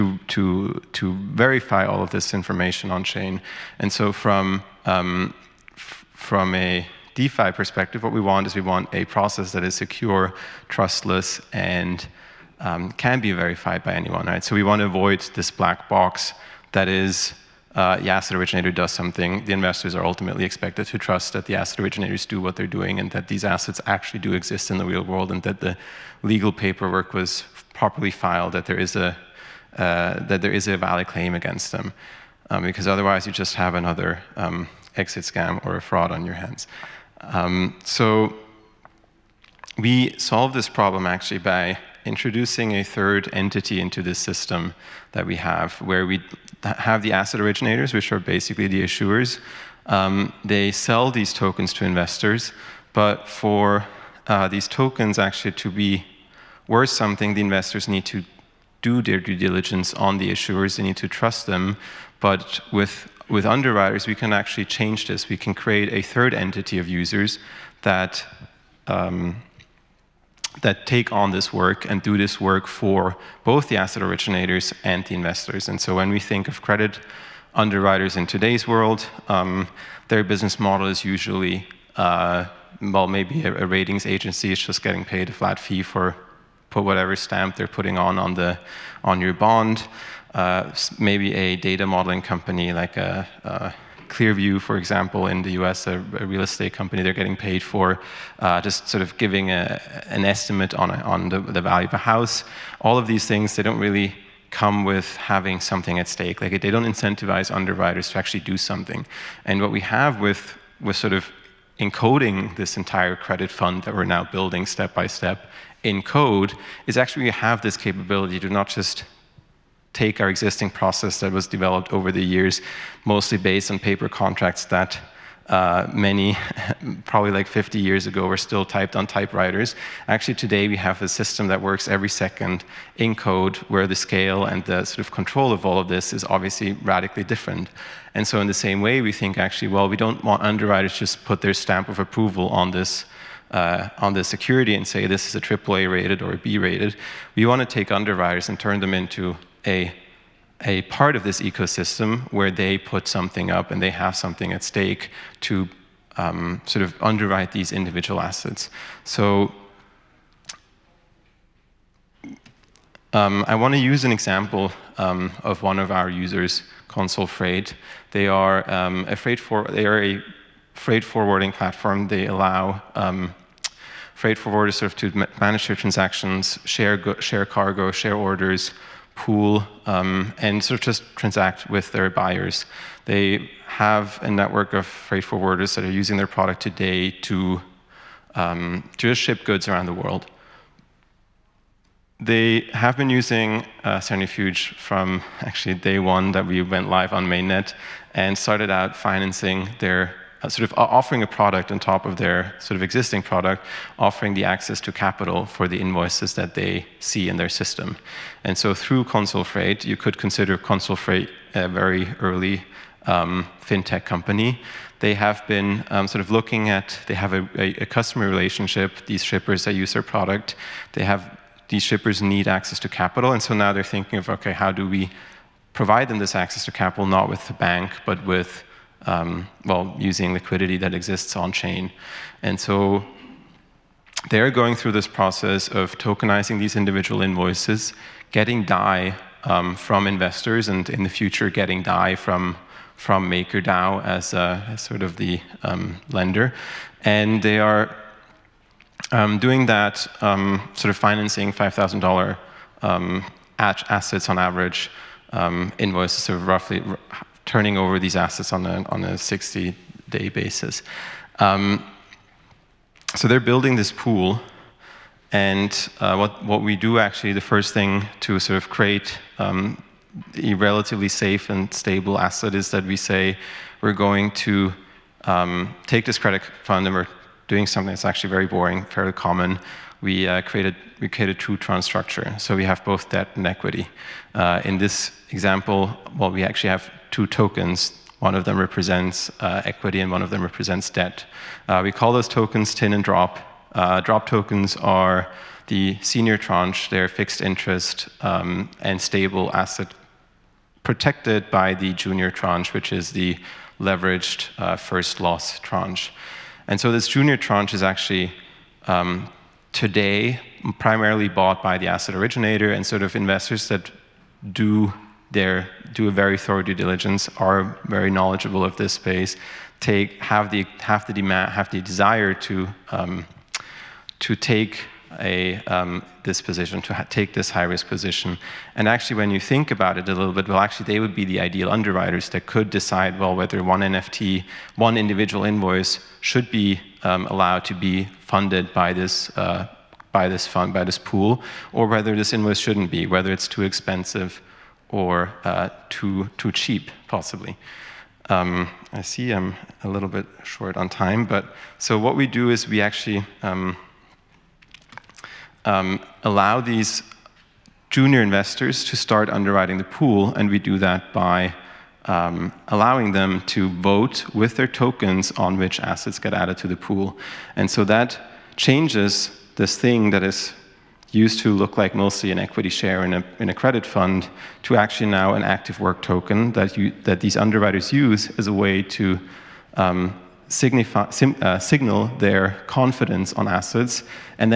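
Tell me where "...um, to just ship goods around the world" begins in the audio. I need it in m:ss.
3:08.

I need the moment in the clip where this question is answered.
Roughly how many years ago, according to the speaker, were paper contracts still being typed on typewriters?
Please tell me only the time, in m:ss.
2:07.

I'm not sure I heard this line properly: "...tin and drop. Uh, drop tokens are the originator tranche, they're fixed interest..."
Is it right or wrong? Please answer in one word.
wrong.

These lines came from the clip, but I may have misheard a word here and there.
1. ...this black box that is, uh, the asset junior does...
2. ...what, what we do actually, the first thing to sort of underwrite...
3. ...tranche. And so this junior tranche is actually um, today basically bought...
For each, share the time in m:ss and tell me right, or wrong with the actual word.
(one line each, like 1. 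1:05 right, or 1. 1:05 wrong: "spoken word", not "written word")
1. 0:15 wrong: "originator", not "junior"
2. 4:26 wrong: "create", not "underwrite"
3. 5:05 wrong: "primarily", not "basically".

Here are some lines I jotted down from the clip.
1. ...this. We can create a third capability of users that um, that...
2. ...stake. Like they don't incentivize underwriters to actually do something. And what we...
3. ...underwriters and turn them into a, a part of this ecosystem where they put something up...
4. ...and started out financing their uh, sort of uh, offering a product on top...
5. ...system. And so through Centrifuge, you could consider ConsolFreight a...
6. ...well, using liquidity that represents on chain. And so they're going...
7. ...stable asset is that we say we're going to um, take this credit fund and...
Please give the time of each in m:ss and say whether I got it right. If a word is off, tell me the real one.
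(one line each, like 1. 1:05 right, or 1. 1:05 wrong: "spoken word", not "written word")
1. 1:05 wrong: "entity", not "capability"
2. 1:46 right
3. 2:27 right
4. 3:18 right
5. 3:27 wrong: "ConsolFreight", not "Centrifuge"
6. 3:49 wrong: "exists", not "represents"
7. 4:31 right.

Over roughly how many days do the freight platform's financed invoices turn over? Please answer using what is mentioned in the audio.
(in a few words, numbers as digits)
60 days.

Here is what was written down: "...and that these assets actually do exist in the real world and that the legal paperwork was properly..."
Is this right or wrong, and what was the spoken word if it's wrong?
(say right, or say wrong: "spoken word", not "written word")
right.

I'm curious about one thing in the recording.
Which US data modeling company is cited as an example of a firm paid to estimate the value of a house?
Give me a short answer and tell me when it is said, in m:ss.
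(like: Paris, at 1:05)
Clearview, at 1:34.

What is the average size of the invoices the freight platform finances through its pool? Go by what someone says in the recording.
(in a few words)
$5,000.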